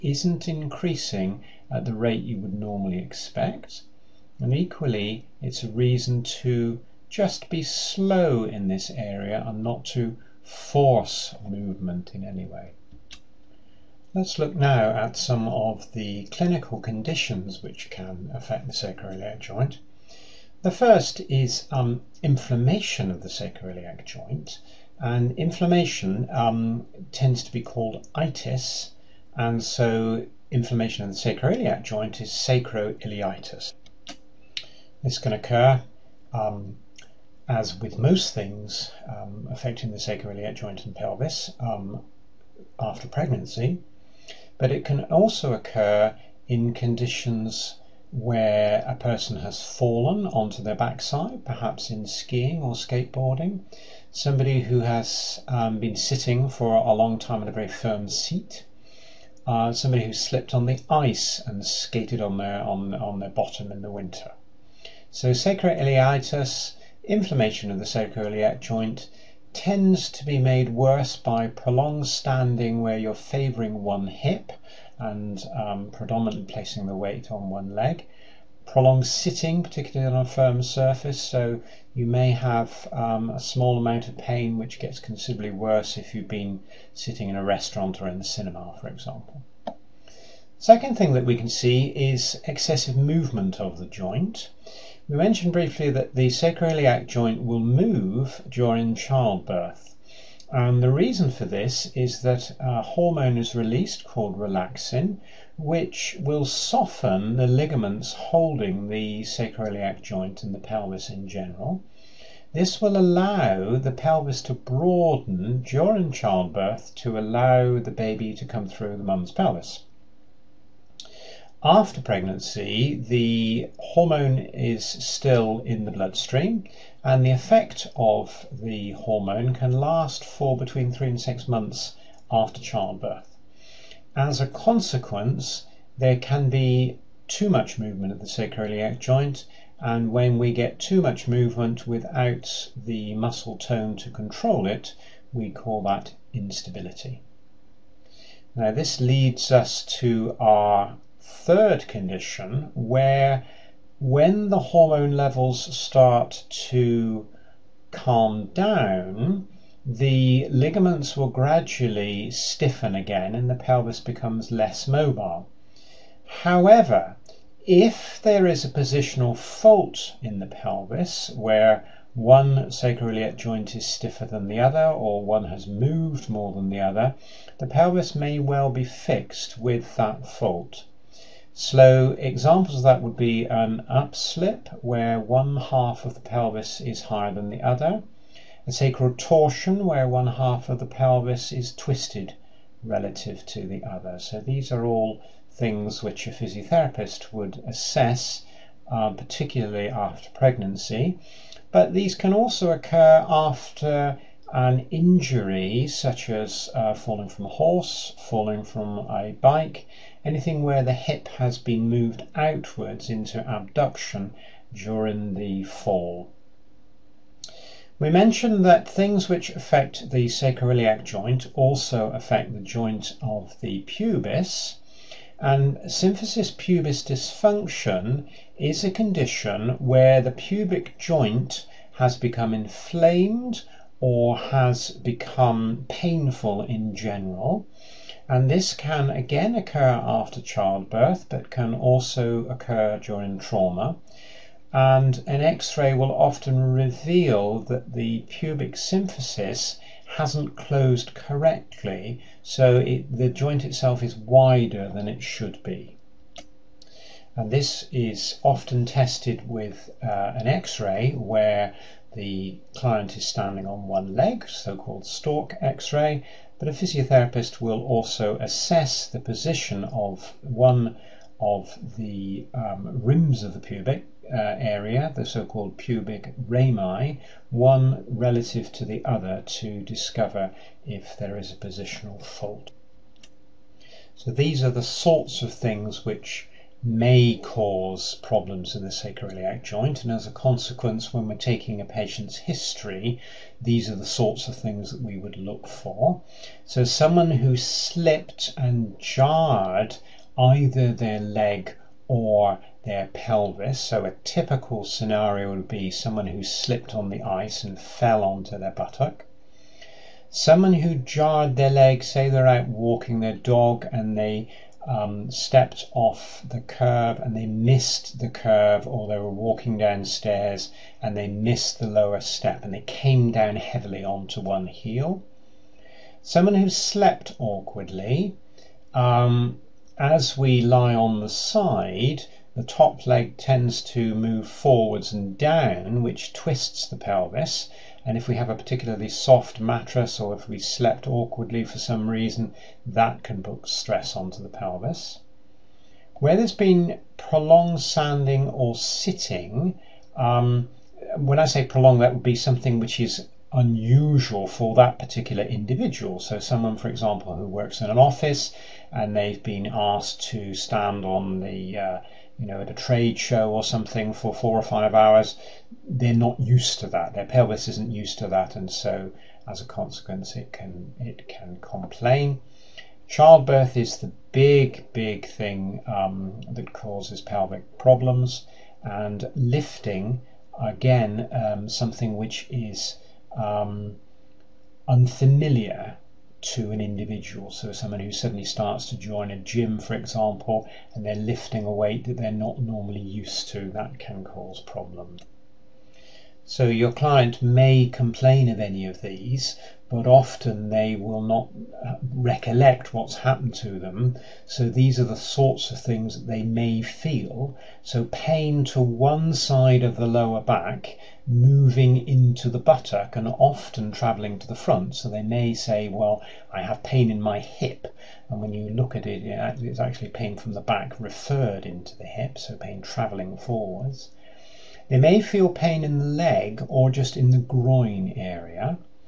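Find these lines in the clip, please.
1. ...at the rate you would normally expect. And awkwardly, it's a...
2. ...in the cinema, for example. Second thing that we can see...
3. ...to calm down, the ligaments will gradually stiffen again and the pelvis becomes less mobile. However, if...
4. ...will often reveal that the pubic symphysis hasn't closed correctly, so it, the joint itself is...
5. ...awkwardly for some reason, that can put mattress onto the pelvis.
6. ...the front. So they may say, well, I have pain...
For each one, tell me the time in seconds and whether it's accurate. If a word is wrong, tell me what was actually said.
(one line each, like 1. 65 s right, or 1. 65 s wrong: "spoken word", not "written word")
1. 1 s wrong: "equally", not "awkwardly"
2. 88 s right
3. 156 s right
4. 245 s right
5. 341 s wrong: "stress", not "mattress"
6. 414 s right.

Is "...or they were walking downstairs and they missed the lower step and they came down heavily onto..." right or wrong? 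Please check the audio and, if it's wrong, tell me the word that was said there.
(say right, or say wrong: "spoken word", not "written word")
right.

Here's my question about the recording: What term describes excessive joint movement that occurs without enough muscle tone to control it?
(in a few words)
Instability.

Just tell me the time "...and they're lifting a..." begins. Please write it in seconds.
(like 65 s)
390 s.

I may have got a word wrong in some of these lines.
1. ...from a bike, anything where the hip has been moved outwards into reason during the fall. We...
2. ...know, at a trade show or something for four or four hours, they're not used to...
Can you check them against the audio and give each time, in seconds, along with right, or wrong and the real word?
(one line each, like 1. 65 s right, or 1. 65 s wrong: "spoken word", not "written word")
1. 208 s wrong: "abduction", not "reason"
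2. 362 s wrong: "five", not "four".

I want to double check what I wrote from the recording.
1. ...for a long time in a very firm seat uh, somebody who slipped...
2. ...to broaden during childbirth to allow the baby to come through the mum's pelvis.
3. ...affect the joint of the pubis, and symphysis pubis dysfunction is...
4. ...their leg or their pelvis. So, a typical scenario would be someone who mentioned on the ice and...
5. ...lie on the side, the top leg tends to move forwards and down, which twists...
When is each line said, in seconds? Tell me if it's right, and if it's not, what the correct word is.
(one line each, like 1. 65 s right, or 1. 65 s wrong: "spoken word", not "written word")
1. 56 s right
2. 114 s right
3. 222 s right
4. 300 s wrong: "slipped", not "mentioned"
5. 330 s right.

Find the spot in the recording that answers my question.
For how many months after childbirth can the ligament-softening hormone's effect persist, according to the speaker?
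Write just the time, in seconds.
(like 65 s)
130 s.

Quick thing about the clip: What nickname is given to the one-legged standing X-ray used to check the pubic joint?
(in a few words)
Stork x-ray.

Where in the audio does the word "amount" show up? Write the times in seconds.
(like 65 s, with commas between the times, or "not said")
83 s.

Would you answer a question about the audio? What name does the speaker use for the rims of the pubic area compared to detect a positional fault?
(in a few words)
Pubic rami.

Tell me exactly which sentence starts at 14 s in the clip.
Let's look now at some of the clinical conditions which can affect the sacroiliac joint.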